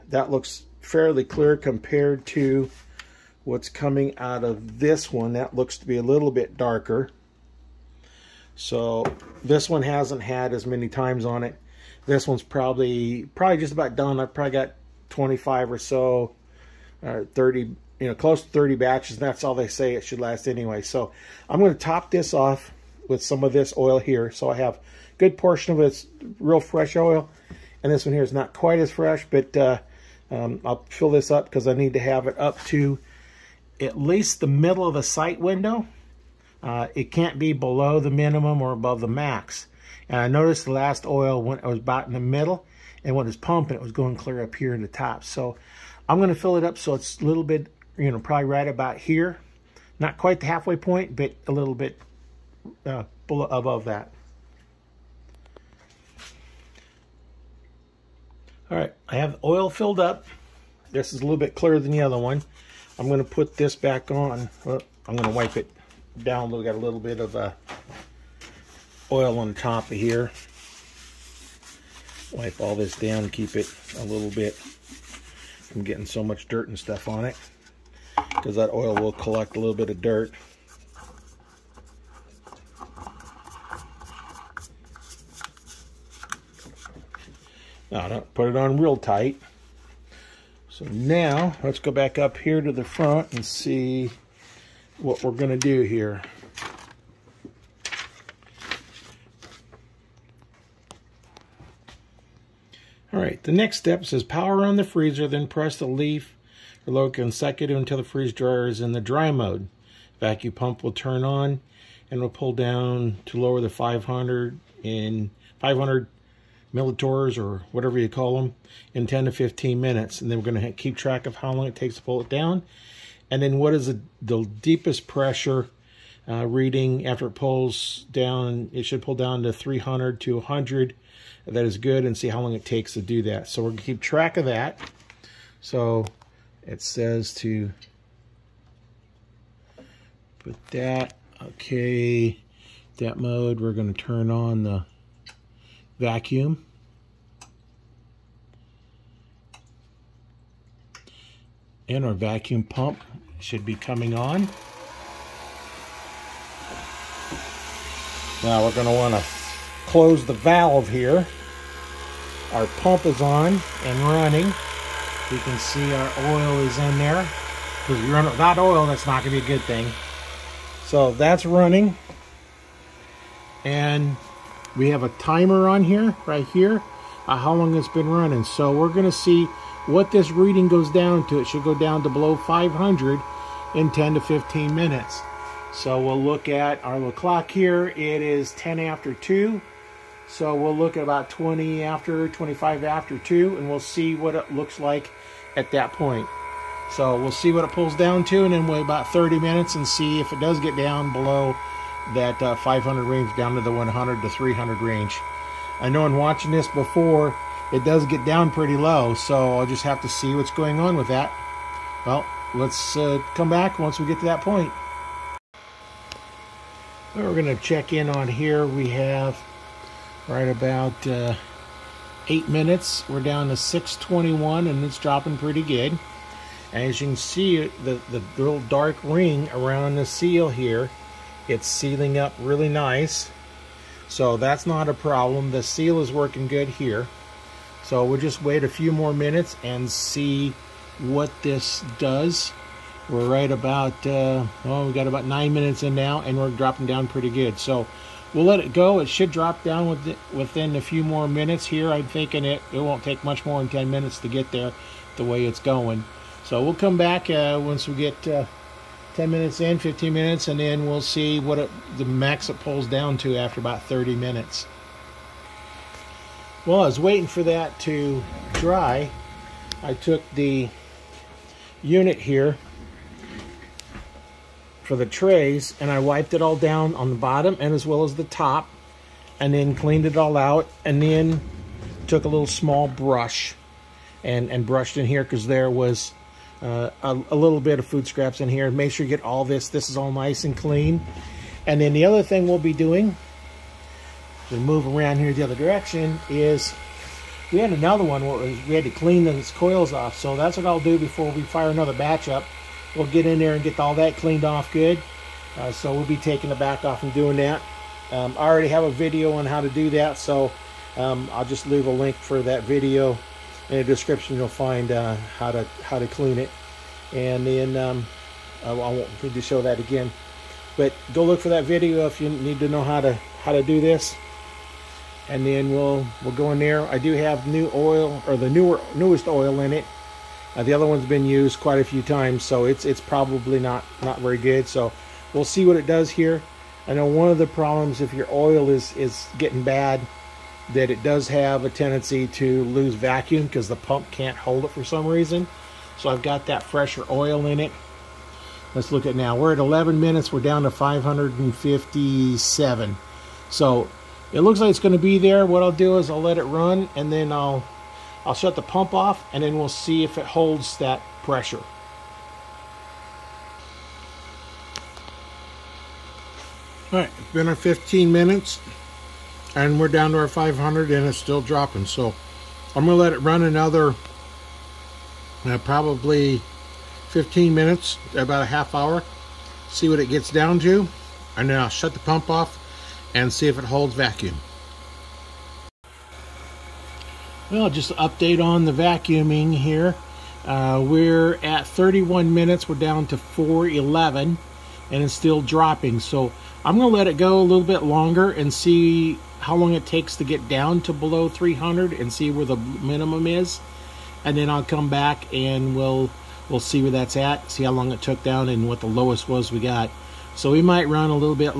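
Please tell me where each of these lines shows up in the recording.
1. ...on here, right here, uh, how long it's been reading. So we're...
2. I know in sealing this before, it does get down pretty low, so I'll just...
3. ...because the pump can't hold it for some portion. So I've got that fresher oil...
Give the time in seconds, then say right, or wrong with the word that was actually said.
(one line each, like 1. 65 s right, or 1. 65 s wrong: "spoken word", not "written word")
1. 175 s wrong: "running", not "reading"
2. 205 s wrong: "watching", not "sealing"
3. 343 s wrong: "reason", not "portion".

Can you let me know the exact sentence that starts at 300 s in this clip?
So that's what I'll do before we fire another batch up.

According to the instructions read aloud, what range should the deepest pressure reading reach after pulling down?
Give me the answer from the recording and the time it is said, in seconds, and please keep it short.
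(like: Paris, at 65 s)
300 to 100, at 129 s.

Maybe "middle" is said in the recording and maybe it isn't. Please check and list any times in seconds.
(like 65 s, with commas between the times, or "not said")
34 s, 42 s.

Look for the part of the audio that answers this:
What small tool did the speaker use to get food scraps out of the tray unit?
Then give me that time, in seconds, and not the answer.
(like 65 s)
282 s.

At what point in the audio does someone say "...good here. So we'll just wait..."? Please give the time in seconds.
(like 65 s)
236 s.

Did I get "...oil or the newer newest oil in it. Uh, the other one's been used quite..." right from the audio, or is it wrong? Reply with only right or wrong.
right.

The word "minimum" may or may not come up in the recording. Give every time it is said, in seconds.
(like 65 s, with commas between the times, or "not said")
38 s, 402 s.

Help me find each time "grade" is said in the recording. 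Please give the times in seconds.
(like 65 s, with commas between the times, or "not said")
not said.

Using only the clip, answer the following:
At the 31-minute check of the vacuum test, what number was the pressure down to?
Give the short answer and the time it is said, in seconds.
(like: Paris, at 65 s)
411, at 392 s.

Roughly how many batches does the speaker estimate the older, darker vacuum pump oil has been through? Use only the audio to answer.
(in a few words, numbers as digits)
30.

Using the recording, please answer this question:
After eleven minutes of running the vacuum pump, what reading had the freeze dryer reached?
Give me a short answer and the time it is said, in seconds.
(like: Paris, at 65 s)
557, at 350 s.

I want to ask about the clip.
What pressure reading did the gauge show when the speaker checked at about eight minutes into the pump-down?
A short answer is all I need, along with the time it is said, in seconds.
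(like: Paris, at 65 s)
621, at 223 s.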